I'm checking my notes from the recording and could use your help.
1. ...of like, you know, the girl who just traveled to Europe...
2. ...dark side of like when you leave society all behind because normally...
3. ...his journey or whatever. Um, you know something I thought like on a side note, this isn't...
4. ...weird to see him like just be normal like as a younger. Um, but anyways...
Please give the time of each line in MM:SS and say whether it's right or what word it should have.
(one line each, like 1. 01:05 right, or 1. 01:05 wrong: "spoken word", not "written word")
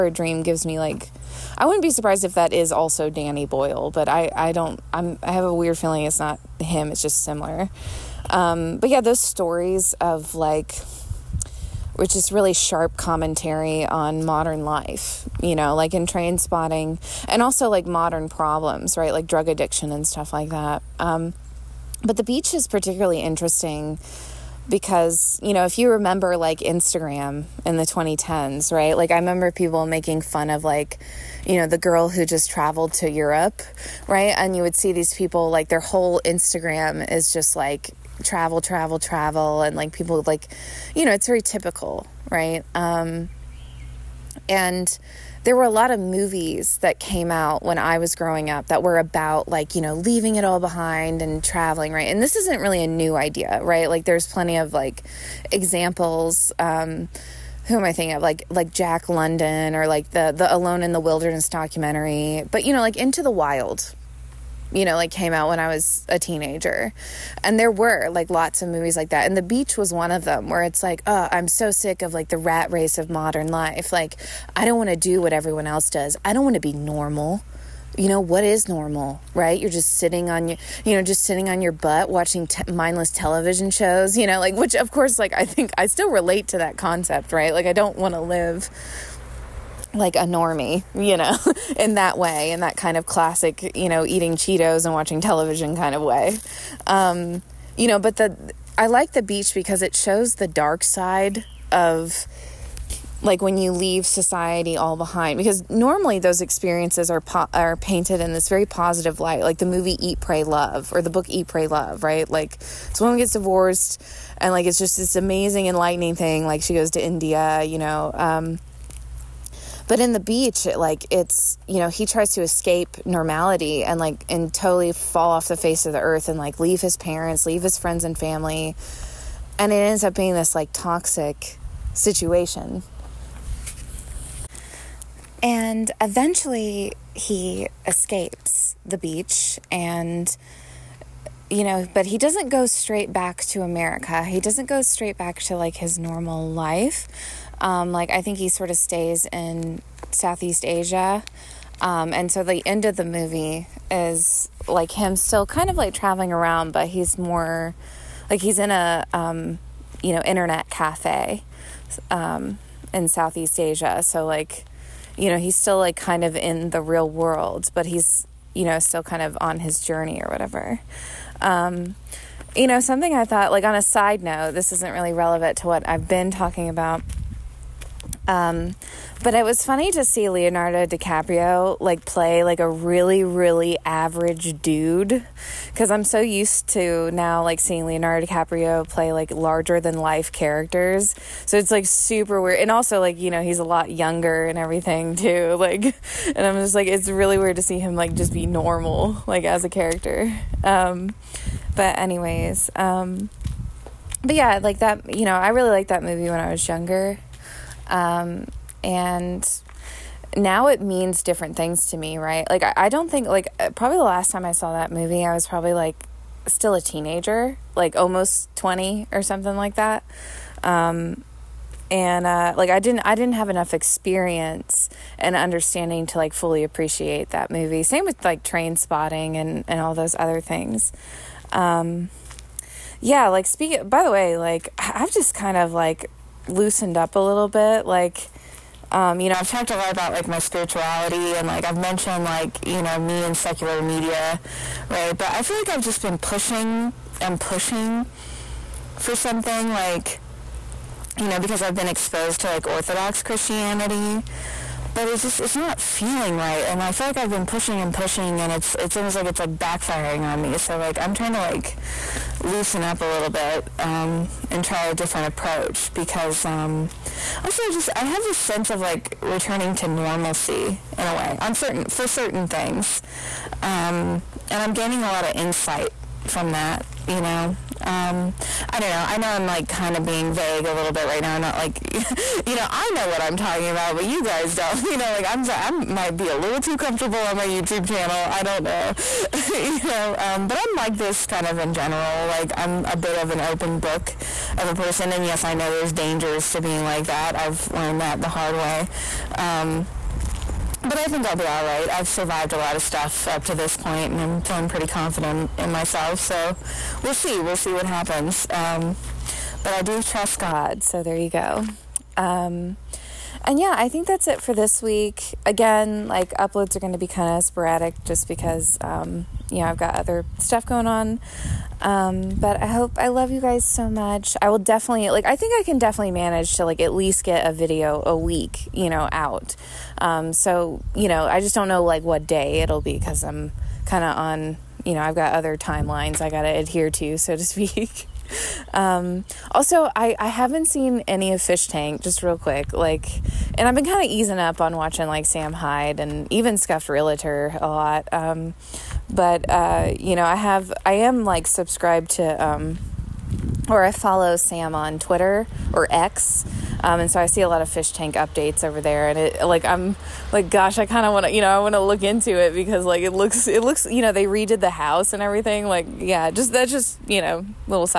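1. 00:30 right
2. 01:40 right
3. 02:49 right
4. 03:17 wrong: "character", not "younger".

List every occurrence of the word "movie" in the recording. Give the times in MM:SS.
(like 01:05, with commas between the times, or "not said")
00:45, 01:08, 01:49, 02:33, 03:26, 03:34, 03:47.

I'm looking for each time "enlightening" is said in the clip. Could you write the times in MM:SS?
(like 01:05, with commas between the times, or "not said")
01:55.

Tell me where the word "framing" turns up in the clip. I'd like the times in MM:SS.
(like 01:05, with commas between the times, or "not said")
not said.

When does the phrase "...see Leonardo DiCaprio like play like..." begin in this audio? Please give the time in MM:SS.
03:00.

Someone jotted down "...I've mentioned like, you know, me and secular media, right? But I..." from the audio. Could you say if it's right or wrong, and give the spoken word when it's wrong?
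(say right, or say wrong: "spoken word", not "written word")
right.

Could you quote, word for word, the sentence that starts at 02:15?
And eventually he escapes the beach and you know, but he doesn't go straight back to America.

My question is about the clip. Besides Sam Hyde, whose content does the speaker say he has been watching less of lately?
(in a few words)
Scuffed Realtor.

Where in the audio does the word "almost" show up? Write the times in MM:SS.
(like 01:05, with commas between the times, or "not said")
03:37, 04:18.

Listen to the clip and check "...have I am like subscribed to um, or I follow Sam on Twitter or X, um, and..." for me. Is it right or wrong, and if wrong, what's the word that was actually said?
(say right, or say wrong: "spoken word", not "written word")
right.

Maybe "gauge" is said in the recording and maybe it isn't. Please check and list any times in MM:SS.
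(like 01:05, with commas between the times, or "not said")
not said.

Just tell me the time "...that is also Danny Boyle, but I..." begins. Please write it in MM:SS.
00:02.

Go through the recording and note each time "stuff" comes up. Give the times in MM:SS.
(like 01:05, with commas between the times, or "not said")
00:20, 05:02, 05:20.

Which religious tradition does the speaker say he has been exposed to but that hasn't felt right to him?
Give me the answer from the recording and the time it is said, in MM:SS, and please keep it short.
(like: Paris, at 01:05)
Orthodox Christianity, at 04:12.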